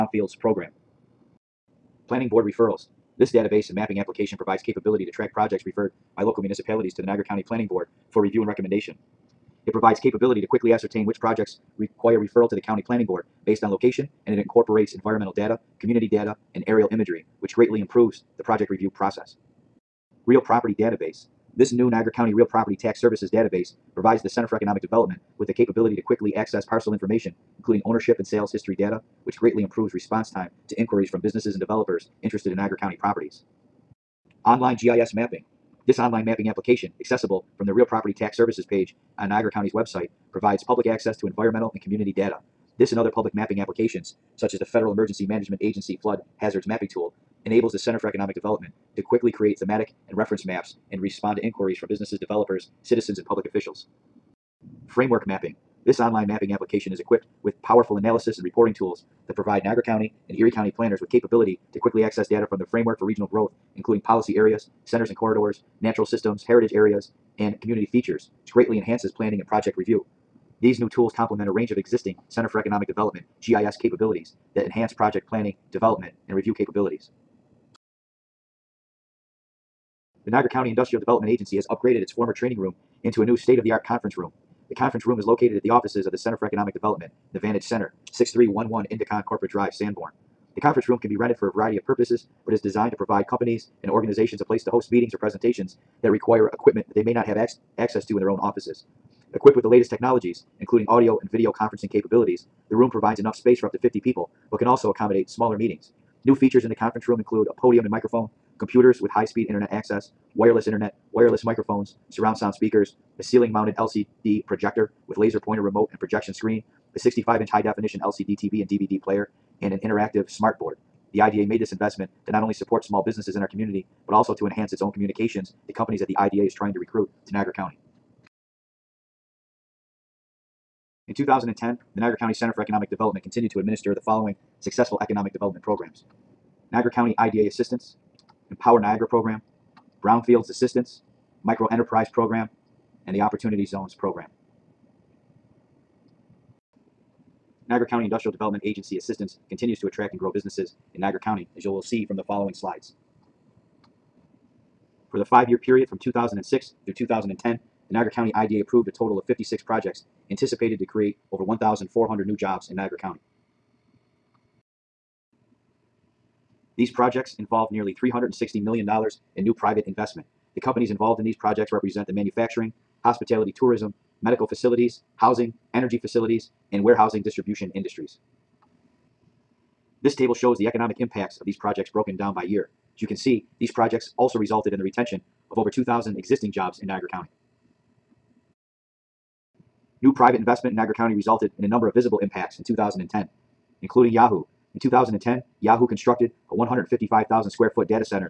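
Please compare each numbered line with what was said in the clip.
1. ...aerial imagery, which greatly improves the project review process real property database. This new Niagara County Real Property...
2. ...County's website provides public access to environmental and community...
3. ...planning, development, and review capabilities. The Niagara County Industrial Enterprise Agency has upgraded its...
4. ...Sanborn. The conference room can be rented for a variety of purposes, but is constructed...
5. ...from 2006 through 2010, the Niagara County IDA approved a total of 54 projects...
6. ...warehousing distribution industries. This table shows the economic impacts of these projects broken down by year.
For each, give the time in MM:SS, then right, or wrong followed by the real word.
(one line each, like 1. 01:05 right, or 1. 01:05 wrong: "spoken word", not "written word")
1. 00:16 right
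2. 00:39 right
3. 01:15 wrong: "Development", not "Enterprise"
4. 01:29 wrong: "designed", not "constructed"
5. 02:35 wrong: "56", not "54"
6. 02:56 right.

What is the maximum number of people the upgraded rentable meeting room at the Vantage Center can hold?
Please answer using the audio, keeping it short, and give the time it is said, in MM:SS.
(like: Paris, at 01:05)
50, at 01:43.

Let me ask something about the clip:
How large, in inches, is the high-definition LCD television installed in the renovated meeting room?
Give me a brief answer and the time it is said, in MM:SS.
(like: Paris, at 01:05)
65-inch, at 01:56.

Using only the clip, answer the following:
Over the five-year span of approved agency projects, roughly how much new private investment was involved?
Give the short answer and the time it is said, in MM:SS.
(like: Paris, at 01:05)
$360 million, at 02:47.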